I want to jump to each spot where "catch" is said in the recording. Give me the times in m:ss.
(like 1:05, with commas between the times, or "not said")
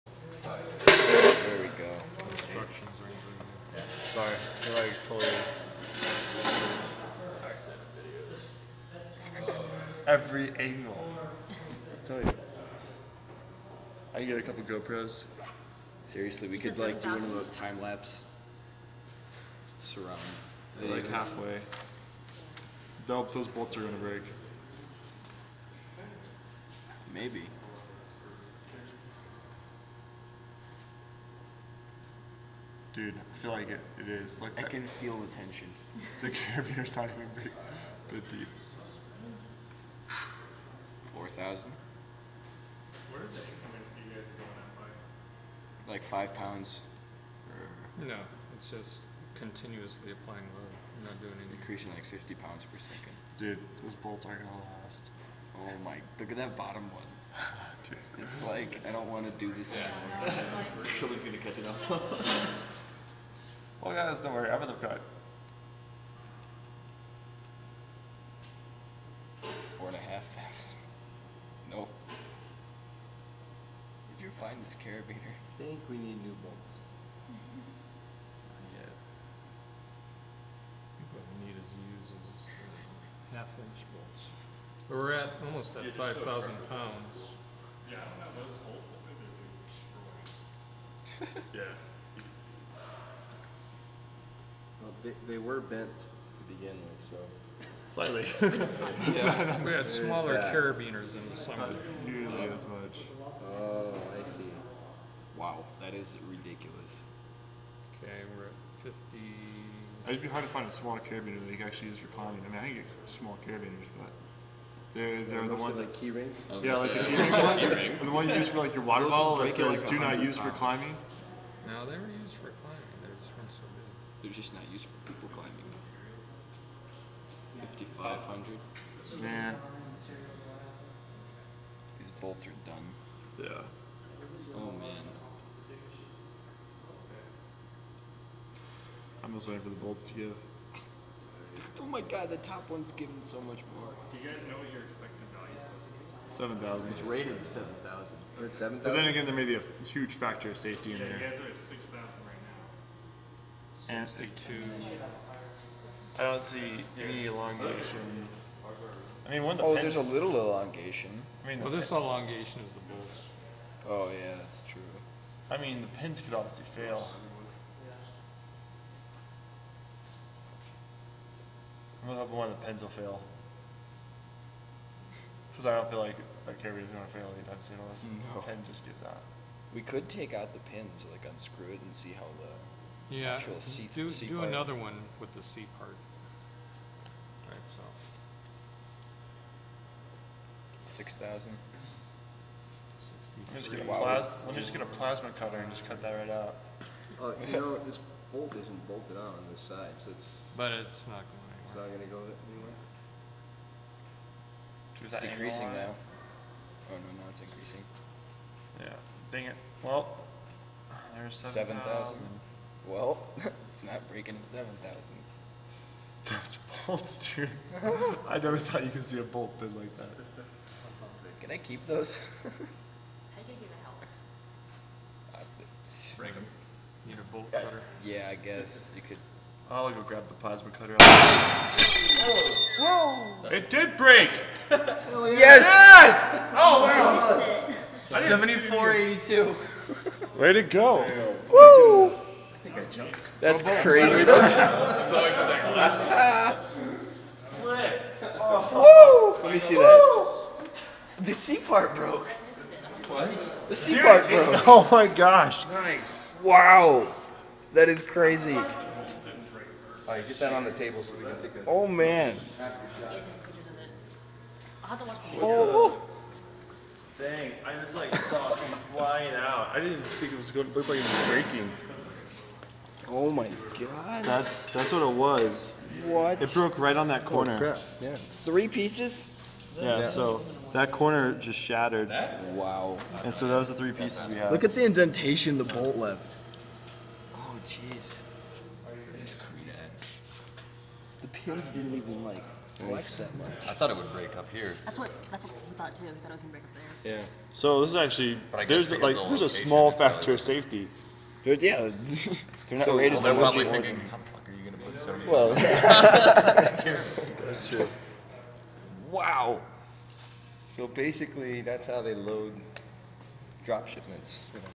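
1:01.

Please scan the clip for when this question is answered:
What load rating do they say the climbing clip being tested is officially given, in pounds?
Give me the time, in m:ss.
2:26.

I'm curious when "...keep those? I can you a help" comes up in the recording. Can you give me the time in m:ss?
3:41.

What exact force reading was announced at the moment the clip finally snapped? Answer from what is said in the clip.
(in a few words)
7482.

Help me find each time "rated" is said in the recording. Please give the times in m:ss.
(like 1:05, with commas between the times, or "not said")
2:27, 5:02.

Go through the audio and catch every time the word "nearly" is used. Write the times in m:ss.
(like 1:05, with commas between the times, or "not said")
1:42.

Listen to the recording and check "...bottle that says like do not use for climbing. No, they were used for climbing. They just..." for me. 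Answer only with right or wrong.
right.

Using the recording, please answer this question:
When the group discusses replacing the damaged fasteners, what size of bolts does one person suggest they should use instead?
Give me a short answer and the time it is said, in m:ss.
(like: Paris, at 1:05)
half-inch, at 1:23.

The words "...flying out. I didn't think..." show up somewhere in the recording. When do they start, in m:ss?
4:28.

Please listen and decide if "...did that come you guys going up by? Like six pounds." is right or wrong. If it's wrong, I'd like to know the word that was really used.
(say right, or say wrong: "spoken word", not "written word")
wrong: "five", not "six".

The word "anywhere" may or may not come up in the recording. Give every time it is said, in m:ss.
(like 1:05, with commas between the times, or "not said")
3:22.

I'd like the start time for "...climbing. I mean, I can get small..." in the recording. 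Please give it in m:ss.
1:52.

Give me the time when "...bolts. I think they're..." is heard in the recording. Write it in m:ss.
1:28.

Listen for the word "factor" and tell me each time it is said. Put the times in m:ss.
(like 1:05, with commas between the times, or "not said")
2:30, 4:59.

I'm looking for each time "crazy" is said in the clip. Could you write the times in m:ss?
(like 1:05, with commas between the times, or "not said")
4:03, 4:18.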